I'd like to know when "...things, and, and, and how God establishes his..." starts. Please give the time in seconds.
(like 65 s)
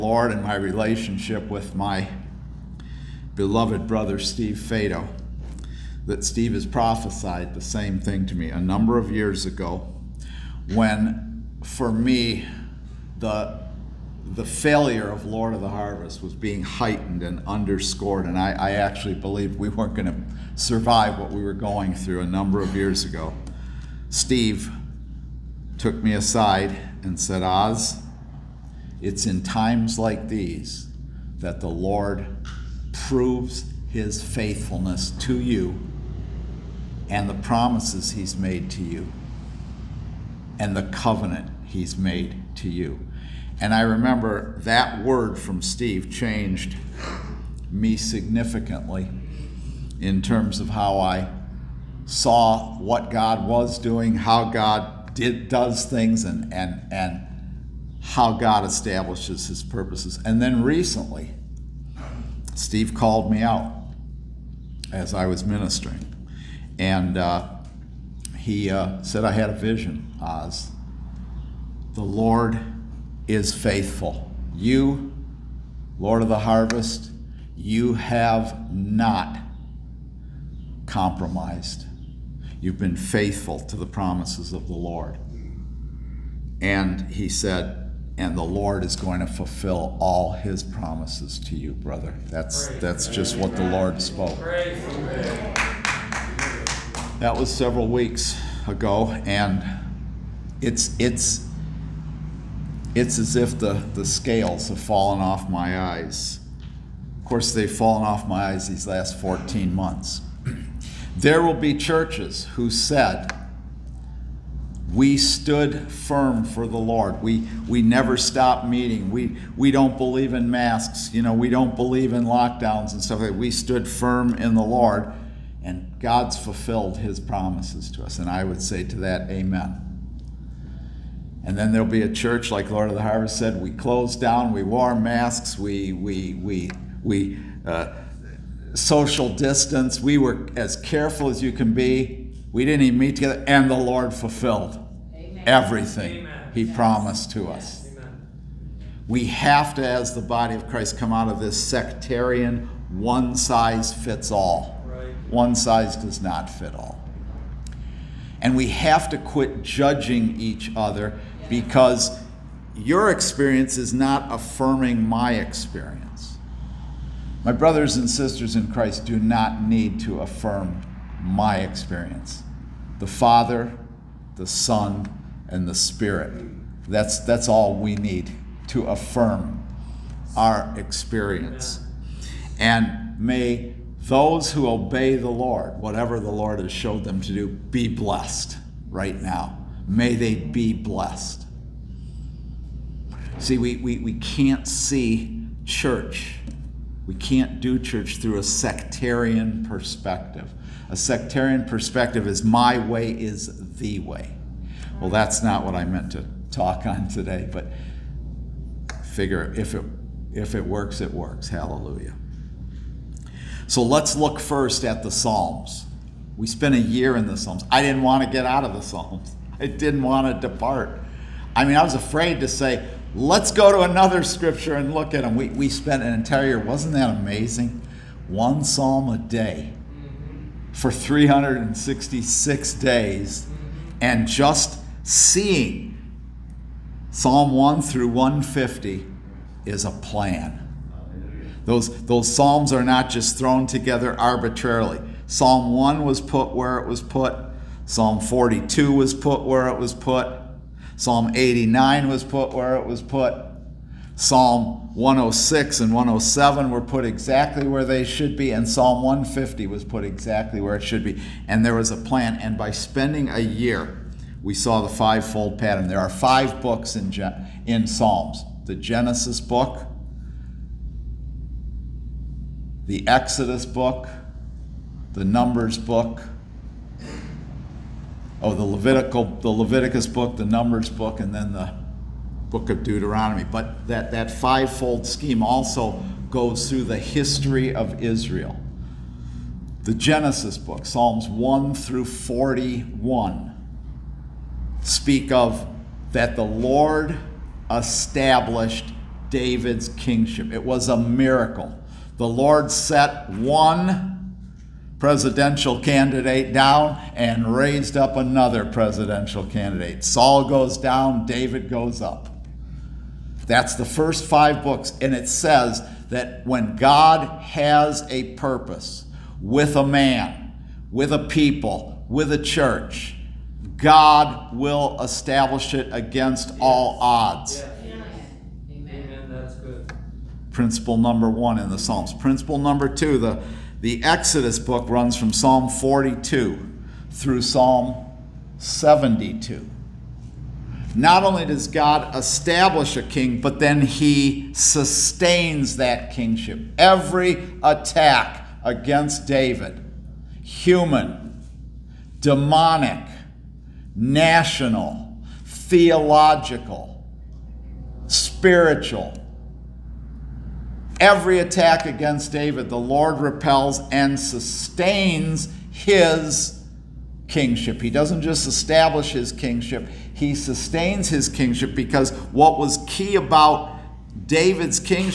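55 s.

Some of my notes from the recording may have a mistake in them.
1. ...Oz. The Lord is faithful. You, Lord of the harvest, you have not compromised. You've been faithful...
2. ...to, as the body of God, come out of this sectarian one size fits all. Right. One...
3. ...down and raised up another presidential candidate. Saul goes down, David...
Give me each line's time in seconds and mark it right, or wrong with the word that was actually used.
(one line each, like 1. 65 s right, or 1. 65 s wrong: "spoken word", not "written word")
1. 70 s right
2. 149 s wrong: "Christ", not "God"
3. 306 s right.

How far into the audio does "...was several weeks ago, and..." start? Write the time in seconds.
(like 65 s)
97 s.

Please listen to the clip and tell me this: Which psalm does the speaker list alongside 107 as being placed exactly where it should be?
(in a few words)
Psalm 106.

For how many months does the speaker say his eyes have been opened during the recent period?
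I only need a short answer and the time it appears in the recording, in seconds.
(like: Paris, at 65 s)
14, at 109 s.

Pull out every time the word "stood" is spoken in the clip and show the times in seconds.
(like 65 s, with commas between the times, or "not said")
115 s, 123 s.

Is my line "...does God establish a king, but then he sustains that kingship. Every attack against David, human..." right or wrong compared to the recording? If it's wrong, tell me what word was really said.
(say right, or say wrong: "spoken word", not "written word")
right.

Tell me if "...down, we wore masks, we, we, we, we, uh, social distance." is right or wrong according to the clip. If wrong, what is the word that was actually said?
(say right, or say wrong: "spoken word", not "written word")
right.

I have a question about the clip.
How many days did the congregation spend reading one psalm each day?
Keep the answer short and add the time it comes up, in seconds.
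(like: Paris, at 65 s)
366, at 230 s.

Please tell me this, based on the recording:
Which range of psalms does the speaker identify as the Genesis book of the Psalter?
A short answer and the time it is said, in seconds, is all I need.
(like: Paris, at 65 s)
Psalms 1 through 41, at 290 s.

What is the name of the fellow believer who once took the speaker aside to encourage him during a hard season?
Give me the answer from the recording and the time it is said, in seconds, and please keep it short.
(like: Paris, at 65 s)
Steve Fado, at 4 s.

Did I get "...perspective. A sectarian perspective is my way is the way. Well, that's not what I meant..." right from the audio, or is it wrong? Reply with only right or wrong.
right.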